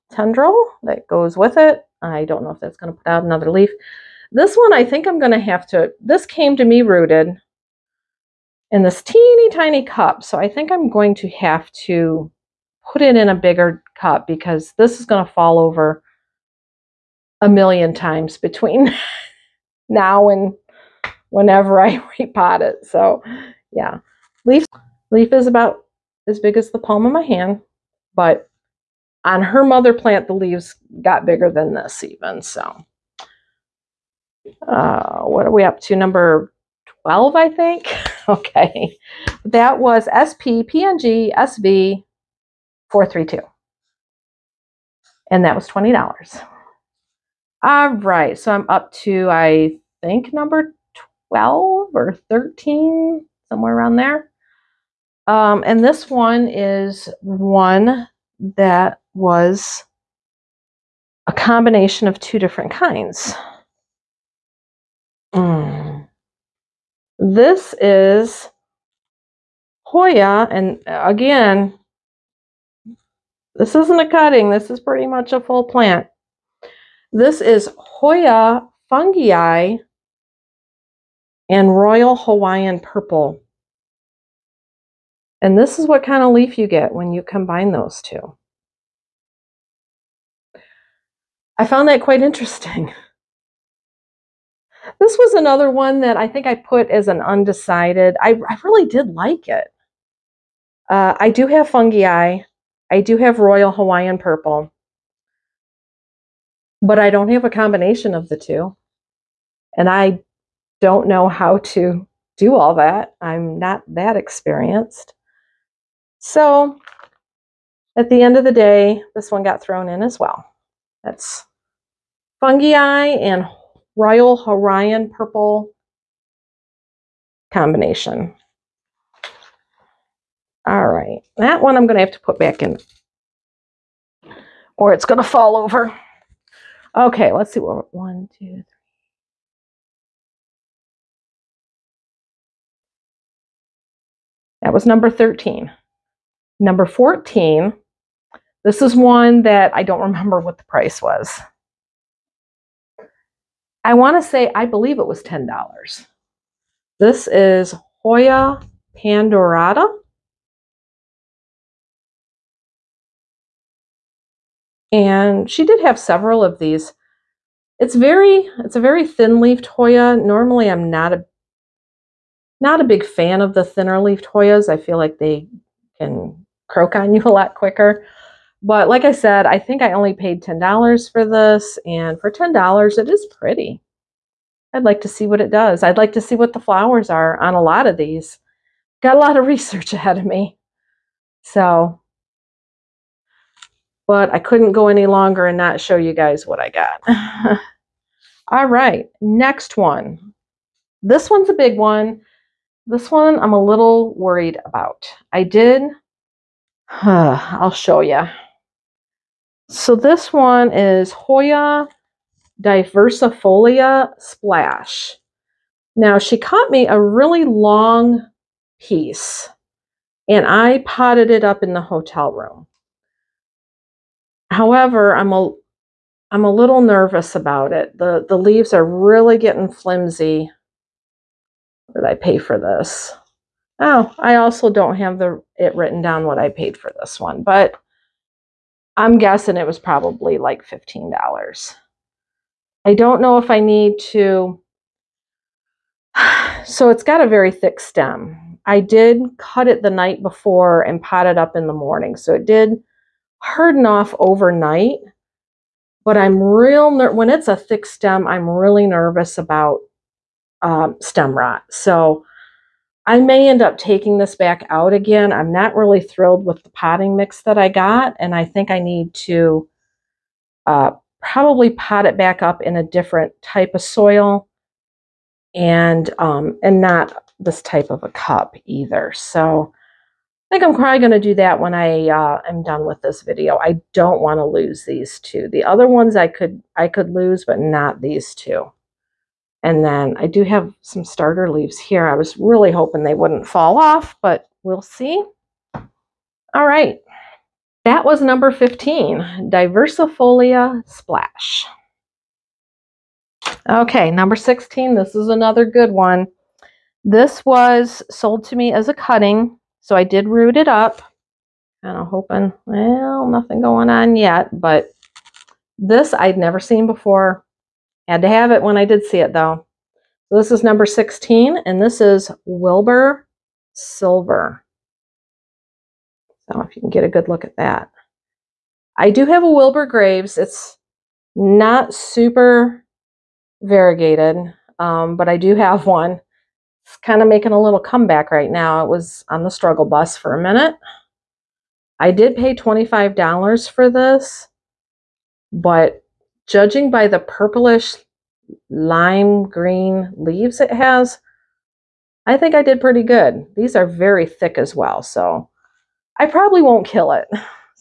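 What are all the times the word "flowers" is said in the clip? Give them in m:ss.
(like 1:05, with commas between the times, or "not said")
3:06.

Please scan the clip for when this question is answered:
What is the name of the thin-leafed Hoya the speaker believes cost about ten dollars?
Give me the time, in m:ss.
2:38.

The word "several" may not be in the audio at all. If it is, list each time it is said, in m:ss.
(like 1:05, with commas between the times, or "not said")
2:45.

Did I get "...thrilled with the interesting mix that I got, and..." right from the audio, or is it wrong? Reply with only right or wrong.
wrong.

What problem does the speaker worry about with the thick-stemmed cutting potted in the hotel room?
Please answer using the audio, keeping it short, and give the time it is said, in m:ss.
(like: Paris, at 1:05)
stem rot, at 4:21.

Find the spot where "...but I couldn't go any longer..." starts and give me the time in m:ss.
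3:14.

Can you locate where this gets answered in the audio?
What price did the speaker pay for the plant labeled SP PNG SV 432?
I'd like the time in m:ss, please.
0:45.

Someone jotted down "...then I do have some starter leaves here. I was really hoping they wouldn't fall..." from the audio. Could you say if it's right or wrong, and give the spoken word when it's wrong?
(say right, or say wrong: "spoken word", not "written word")
right.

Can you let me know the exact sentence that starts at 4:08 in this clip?
I did cut it the night before and pot it up in the morning.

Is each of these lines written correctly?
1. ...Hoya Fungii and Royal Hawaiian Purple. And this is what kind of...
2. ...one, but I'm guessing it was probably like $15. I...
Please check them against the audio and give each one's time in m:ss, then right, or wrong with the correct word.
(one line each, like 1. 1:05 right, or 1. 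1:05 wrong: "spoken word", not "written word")
1. 1:17 right
2. 3:57 right.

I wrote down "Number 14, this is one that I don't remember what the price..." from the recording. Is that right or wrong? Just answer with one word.
right.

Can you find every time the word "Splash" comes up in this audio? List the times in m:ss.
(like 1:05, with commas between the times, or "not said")
3:34, 5:00.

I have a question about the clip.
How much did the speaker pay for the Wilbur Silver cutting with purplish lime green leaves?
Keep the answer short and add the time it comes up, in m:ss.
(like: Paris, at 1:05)
$25, at 5:42.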